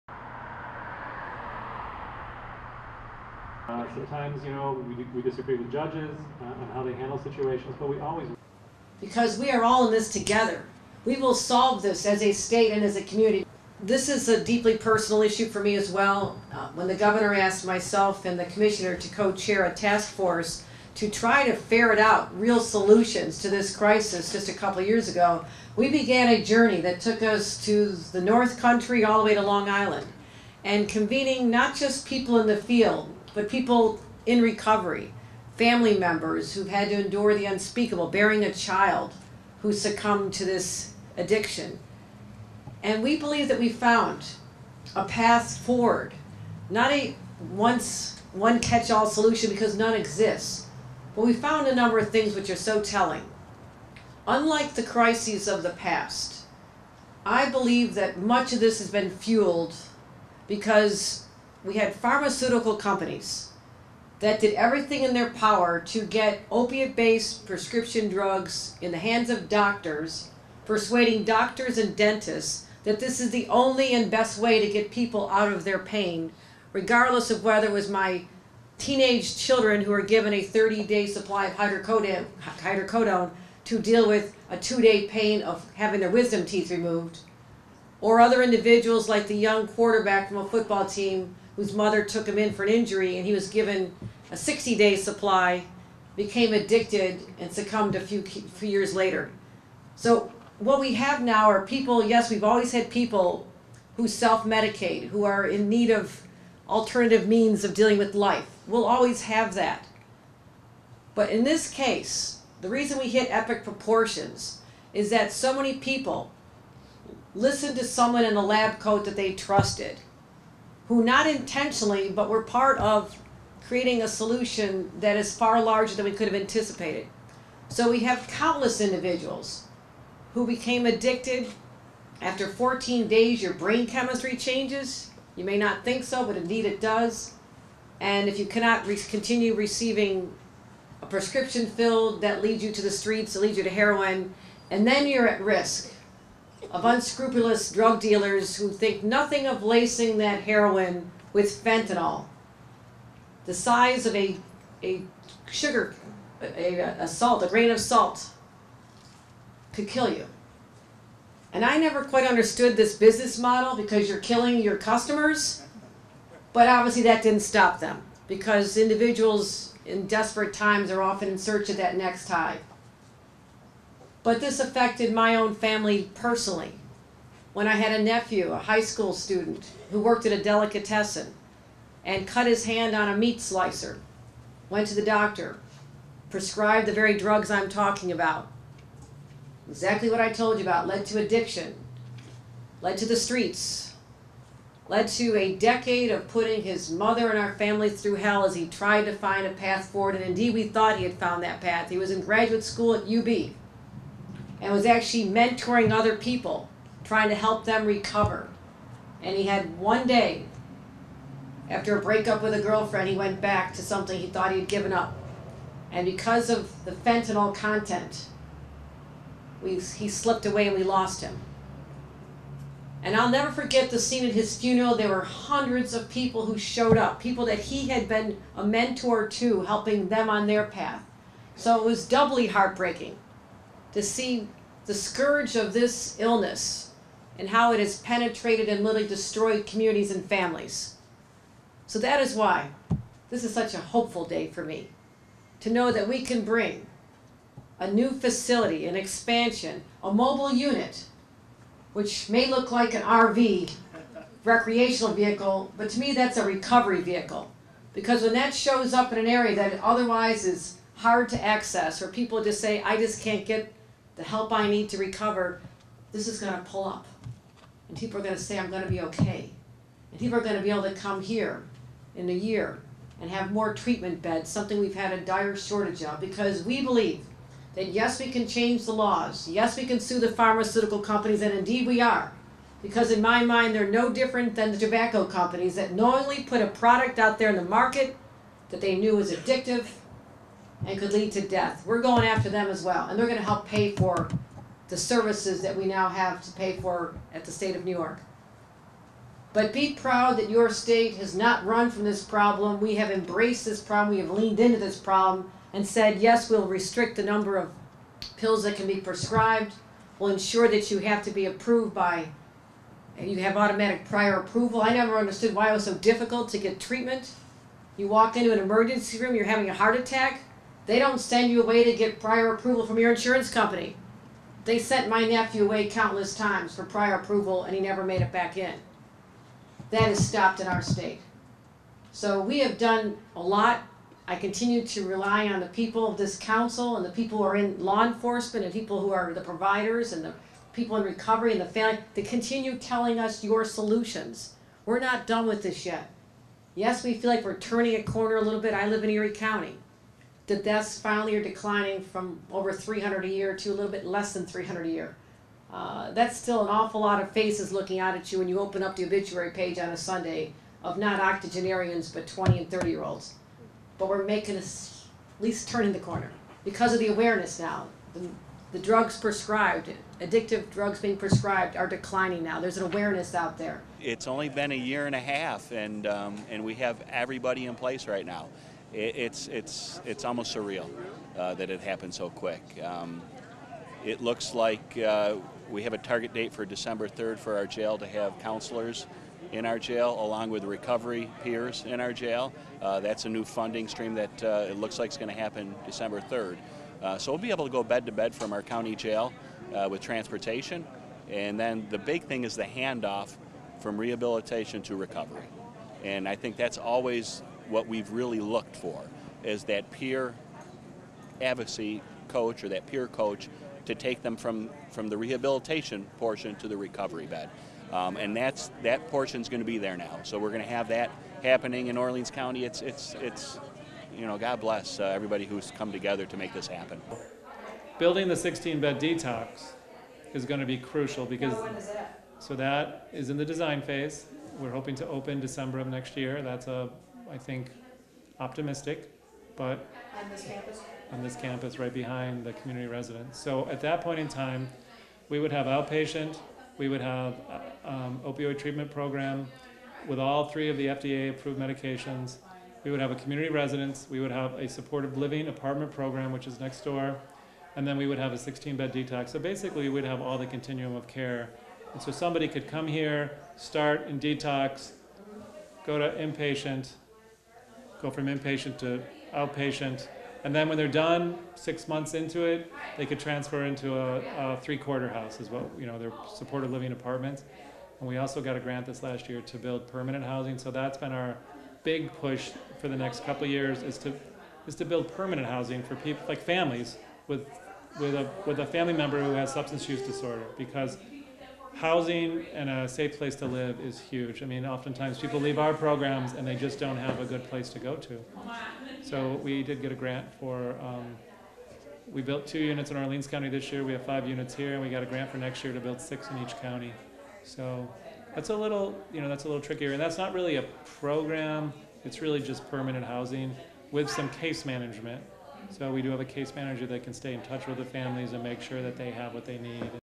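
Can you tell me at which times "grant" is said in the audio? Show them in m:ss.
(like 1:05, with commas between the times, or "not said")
7:58, 8:19, 8:25.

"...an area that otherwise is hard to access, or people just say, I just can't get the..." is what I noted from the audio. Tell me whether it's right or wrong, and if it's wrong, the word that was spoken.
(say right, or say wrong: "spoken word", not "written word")
right.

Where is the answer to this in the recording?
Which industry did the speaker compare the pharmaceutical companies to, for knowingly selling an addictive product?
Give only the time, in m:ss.
4:44.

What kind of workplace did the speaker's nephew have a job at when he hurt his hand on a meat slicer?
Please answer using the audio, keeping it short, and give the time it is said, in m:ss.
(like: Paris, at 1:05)
Delicatessen, at 3:00.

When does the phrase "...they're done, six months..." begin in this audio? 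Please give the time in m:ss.
7:50.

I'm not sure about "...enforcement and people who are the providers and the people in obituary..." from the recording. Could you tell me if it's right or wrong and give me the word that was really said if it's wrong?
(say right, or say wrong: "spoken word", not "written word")
wrong: "recovery", not "obituary".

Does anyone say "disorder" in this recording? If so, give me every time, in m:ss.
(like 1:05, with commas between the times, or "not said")
8:10.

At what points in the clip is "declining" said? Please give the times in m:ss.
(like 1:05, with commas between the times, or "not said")
5:51, 6:11.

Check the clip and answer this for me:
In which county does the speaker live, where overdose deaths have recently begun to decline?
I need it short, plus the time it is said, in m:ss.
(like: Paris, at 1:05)
Erie County, at 5:49.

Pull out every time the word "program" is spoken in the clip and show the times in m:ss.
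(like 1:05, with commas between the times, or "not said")
7:28, 7:35, 8:15, 8:30.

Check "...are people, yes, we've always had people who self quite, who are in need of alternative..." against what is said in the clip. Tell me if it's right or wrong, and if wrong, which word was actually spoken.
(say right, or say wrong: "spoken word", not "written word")
wrong: "medicate", not "quite".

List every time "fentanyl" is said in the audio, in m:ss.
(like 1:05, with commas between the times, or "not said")
2:31, 3:36.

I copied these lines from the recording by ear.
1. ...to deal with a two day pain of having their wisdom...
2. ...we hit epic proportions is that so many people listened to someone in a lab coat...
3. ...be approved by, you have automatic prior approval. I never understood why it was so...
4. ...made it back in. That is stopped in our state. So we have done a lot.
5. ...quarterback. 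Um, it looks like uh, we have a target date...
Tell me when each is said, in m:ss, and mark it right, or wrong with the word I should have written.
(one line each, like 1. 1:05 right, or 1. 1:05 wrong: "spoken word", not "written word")
1. 1:23 right
2. 1:52 right
3. 5:11 right
4. 5:28 right
5. 6:22 wrong: "quick", not "quarterback".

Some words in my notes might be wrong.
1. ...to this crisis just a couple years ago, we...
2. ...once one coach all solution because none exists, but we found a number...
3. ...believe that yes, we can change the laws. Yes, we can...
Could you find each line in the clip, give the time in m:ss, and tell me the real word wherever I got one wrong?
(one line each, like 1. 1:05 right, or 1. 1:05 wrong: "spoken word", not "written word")
1. 0:23 right
2. 0:47 wrong: "catch", not "coach"
3. 4:36 right.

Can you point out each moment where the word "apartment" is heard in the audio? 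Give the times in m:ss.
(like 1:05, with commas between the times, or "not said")
7:35, 7:56.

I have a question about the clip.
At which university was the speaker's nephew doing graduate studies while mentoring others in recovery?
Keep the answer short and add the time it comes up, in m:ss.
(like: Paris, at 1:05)
UB, at 3:23.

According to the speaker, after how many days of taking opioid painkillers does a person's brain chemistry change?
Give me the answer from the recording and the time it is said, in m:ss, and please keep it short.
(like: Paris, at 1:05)
14, at 2:12.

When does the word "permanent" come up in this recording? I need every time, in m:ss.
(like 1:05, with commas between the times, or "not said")
7:59, 8:05, 8:32.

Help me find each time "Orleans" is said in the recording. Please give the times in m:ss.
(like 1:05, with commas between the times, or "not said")
7:01, 8:22.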